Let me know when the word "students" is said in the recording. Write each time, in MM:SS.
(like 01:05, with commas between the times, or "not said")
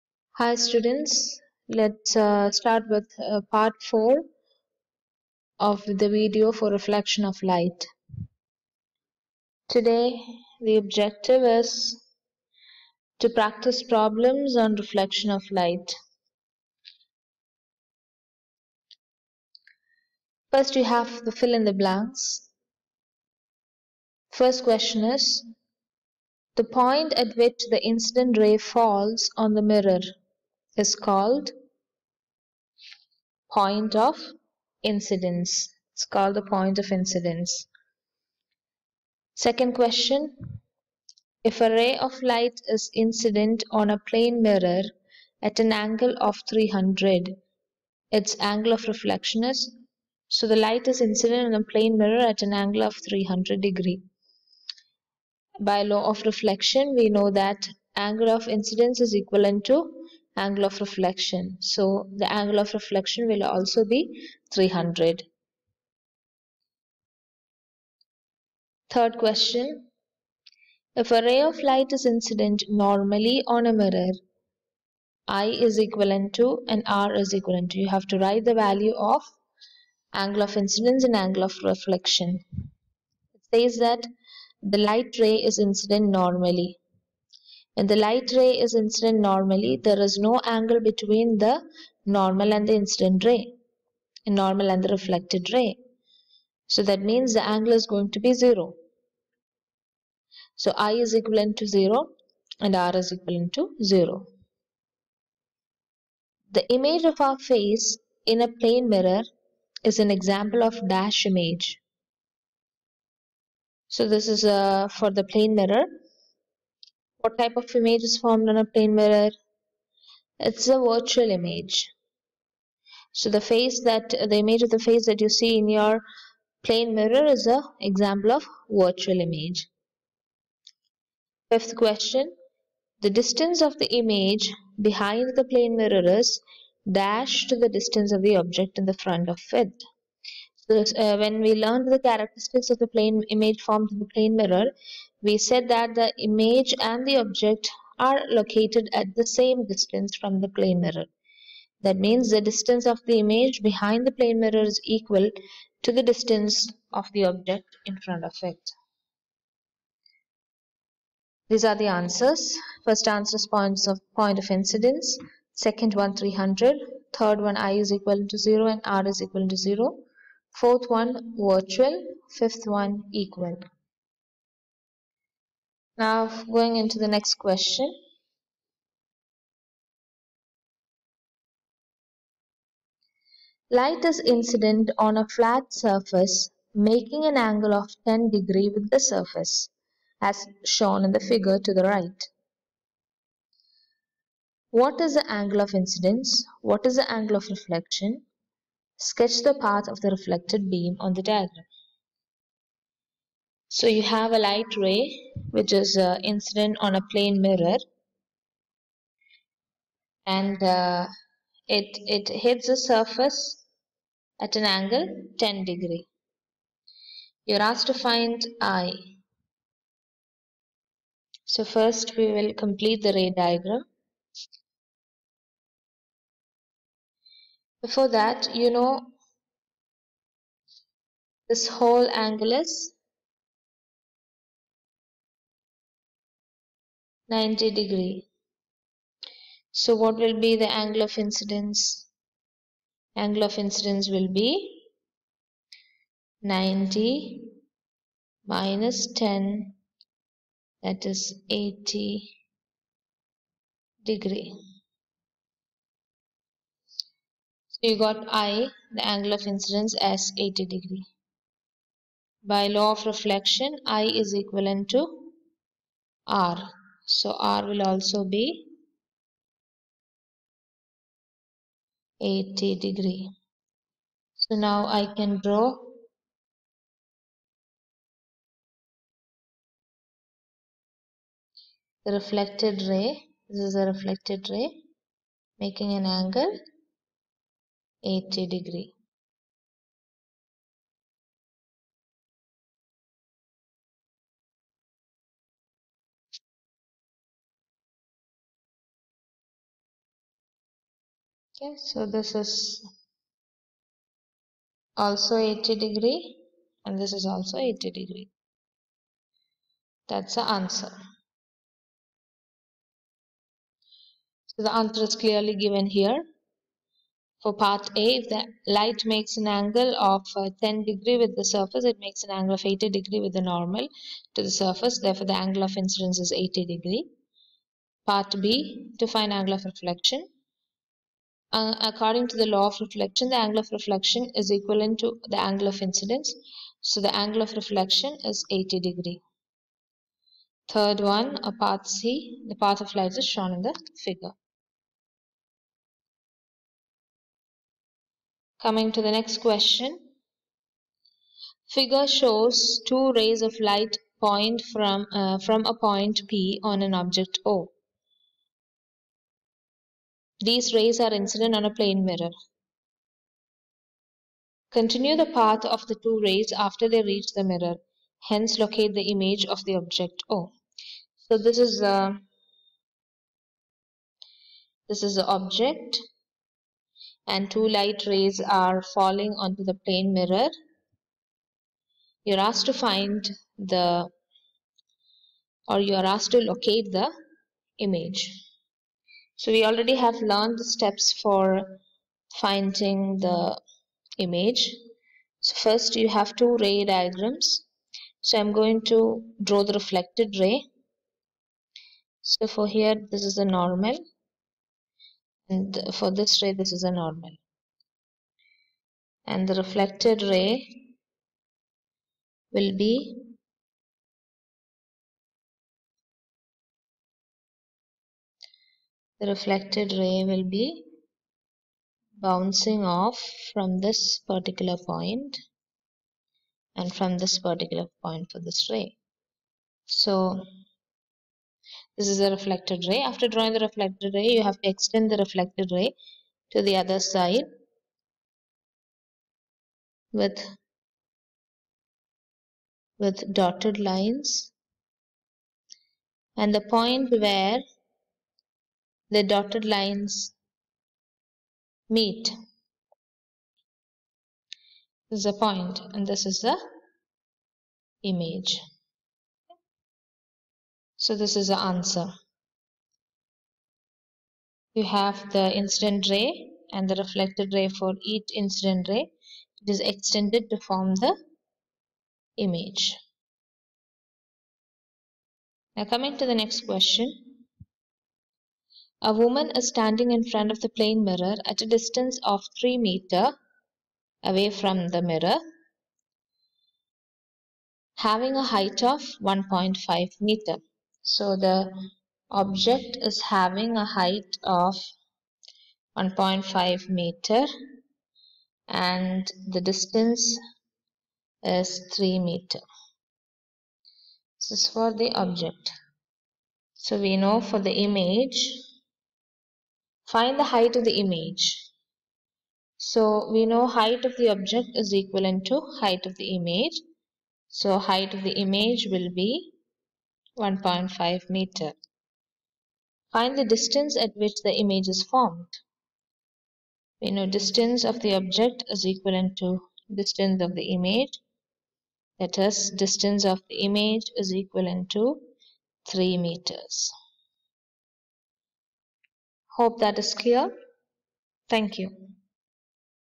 00:00.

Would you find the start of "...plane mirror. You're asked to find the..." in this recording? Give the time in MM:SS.
06:19.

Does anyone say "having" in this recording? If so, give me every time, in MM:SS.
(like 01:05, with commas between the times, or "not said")
08:07, 08:13.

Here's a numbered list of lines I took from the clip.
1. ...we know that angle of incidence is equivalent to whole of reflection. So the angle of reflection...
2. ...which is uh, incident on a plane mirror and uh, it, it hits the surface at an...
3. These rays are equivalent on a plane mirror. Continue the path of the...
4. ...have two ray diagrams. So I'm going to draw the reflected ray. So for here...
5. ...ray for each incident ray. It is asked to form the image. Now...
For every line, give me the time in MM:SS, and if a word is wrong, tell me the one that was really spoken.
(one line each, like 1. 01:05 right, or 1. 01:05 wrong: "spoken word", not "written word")
1. 00:56 wrong: "angle", not "whole"
2. 03:25 right
3. 06:00 wrong: "incident", not "equivalent"
4. 06:36 right
5. 07:47 wrong: "extended", not "asked".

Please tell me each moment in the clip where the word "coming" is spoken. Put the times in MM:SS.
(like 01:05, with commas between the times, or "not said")
05:48, 07:55.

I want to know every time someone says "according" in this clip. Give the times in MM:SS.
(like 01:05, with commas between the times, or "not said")
05:31.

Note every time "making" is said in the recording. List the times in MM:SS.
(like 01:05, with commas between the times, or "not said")
03:06, 04:45.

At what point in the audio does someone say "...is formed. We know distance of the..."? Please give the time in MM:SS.
08:44.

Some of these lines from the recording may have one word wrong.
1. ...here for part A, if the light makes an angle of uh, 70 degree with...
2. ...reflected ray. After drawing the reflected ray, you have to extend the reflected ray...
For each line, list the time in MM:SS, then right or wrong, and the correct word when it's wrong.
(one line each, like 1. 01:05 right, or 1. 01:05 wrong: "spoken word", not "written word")
1. 05:15 wrong: "10", not "70"
2. 07:12 right.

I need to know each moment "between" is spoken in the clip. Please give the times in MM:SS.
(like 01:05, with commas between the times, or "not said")
01:30.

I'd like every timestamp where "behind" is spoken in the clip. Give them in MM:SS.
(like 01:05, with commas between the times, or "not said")
02:14, 02:33.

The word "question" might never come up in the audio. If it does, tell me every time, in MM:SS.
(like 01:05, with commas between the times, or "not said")
00:24, 00:39, 01:09, 02:11, 02:57, 05:49, 07:56.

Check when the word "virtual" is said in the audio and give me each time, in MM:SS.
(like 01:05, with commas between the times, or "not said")
02:00, 02:08, 02:51.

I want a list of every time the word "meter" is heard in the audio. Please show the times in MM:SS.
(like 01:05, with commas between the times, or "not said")
08:02, 08:10, 08:16, 08:22, 08:41, 08:56.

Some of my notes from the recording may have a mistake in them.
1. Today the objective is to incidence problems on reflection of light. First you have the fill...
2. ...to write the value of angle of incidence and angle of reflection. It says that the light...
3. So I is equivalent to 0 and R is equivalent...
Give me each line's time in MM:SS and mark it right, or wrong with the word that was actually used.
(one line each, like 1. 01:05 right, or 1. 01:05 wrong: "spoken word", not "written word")
1. 00:09 wrong: "practice", not "incidence"
2. 01:18 right
3. 01:40 right.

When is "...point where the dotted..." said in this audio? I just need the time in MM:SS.
07:26.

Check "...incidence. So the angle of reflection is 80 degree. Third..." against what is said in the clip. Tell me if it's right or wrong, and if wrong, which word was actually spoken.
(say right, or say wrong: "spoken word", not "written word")
right.